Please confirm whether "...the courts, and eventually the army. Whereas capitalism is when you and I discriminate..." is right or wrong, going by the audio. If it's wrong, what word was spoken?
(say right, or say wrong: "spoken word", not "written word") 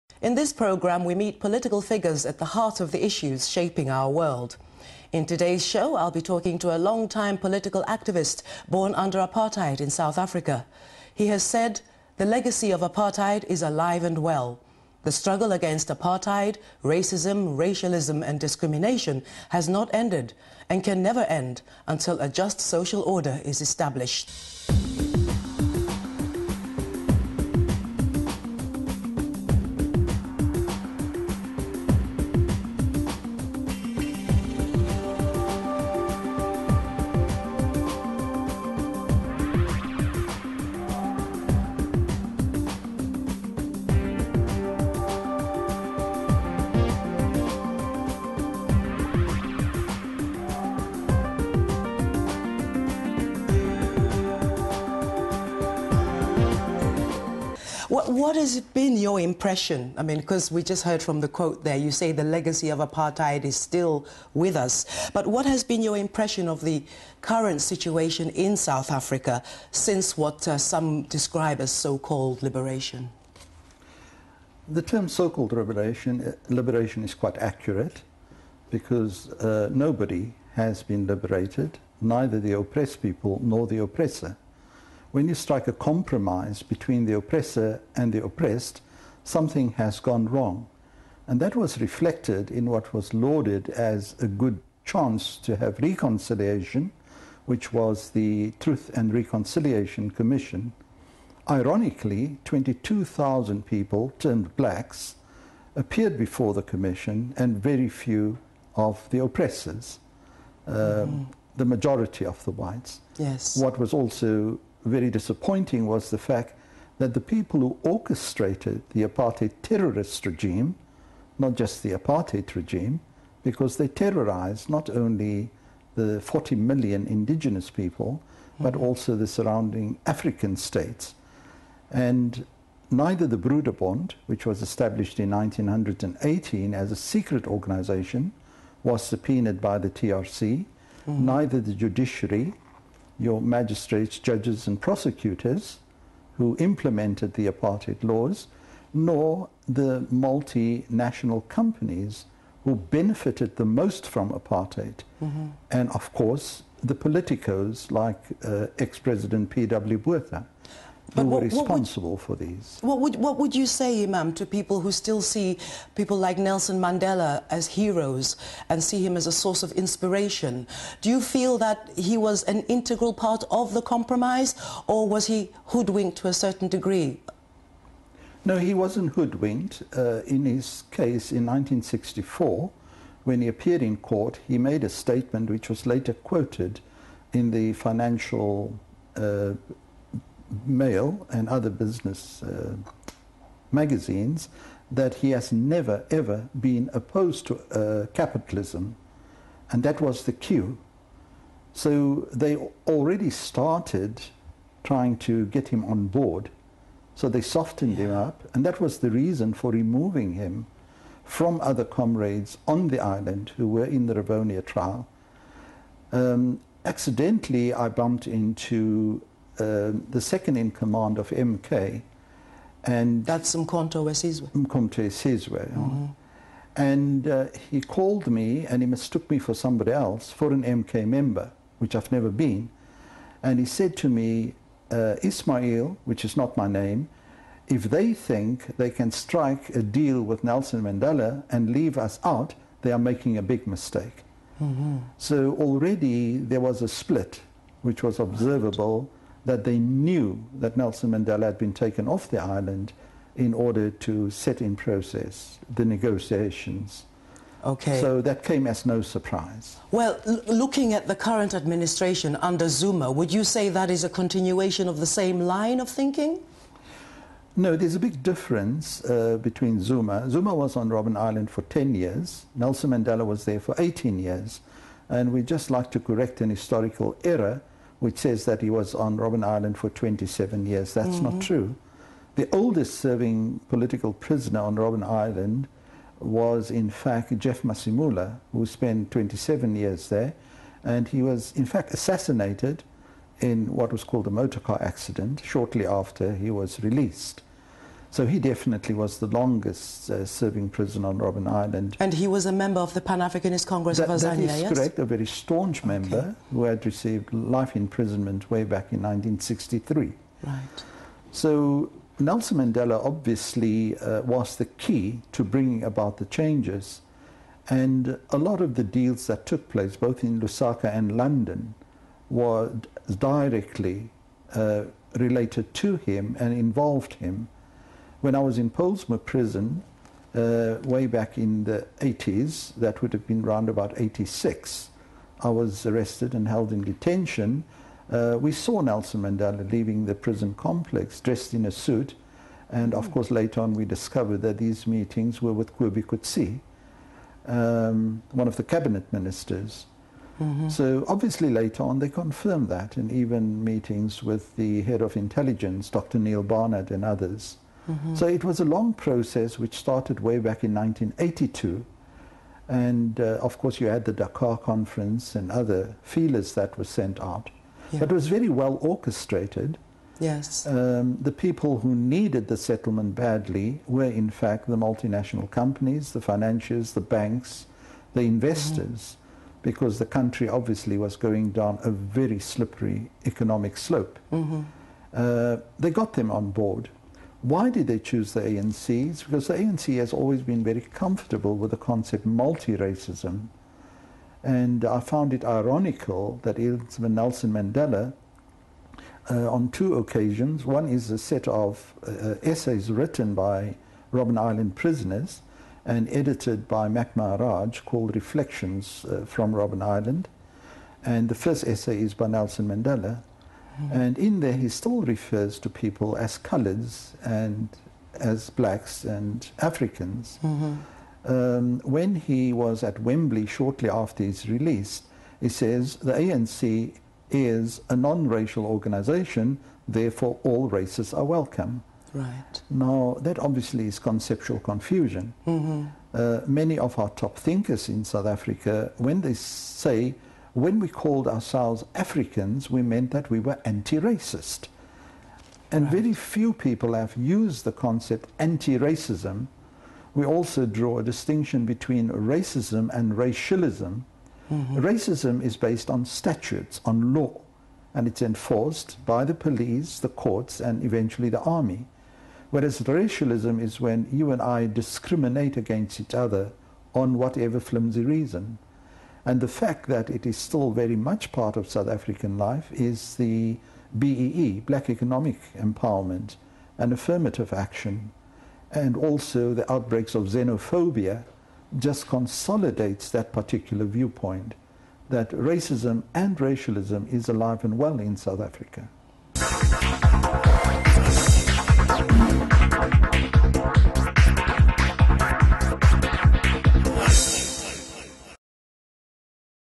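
wrong: "racialism", not "capitalism".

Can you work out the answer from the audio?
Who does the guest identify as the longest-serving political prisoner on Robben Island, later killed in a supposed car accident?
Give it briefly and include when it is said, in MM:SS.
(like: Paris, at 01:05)
Jeff Masemola, at 04:47.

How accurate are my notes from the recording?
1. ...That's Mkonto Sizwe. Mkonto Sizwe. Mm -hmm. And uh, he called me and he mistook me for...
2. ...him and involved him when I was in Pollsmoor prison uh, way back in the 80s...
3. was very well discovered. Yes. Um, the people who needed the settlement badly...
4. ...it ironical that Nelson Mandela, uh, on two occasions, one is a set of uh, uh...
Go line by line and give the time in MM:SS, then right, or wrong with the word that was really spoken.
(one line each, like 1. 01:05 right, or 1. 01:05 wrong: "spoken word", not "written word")
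1. 03:43 right
2. 05:25 right
3. 06:08 wrong: "orchestrated", not "discovered"
4. 06:35 right.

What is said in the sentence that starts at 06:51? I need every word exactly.
And the first essay is by Nelson Mandela.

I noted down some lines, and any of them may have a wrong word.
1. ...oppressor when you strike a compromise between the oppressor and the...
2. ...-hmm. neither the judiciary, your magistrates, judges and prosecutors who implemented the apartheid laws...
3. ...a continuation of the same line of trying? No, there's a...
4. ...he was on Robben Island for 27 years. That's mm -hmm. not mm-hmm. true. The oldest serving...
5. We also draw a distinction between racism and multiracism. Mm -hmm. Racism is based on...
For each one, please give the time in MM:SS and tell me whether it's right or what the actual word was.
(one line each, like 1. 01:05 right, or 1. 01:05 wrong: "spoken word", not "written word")
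1. 01:23 right
2. 02:21 right
3. 04:24 wrong: "thinking", not "trying"
4. 04:38 right
5. 07:30 wrong: "racialism", not "multiracism".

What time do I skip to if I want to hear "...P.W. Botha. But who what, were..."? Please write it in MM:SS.
02:39.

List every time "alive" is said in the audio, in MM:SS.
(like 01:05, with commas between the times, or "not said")
00:13, 08:07.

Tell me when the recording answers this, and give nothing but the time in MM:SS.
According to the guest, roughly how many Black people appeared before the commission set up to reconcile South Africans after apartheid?
01:42.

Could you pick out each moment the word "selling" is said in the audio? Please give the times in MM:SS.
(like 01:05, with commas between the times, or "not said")
not said.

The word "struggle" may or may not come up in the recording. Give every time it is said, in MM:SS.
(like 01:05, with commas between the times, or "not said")
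00:15.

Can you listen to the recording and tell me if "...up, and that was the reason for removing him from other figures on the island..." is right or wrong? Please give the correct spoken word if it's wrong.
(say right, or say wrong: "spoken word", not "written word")
wrong: "comrades", not "figures".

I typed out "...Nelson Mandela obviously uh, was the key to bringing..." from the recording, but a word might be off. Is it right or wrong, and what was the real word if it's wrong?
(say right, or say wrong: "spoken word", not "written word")
right.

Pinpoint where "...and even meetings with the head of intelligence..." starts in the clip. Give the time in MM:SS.
05:52.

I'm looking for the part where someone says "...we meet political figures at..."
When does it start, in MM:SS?
00:01.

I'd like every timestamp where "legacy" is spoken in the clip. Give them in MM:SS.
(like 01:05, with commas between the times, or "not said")
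00:12, 01:02.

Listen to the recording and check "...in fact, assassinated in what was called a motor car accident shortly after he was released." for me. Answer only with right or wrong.
right.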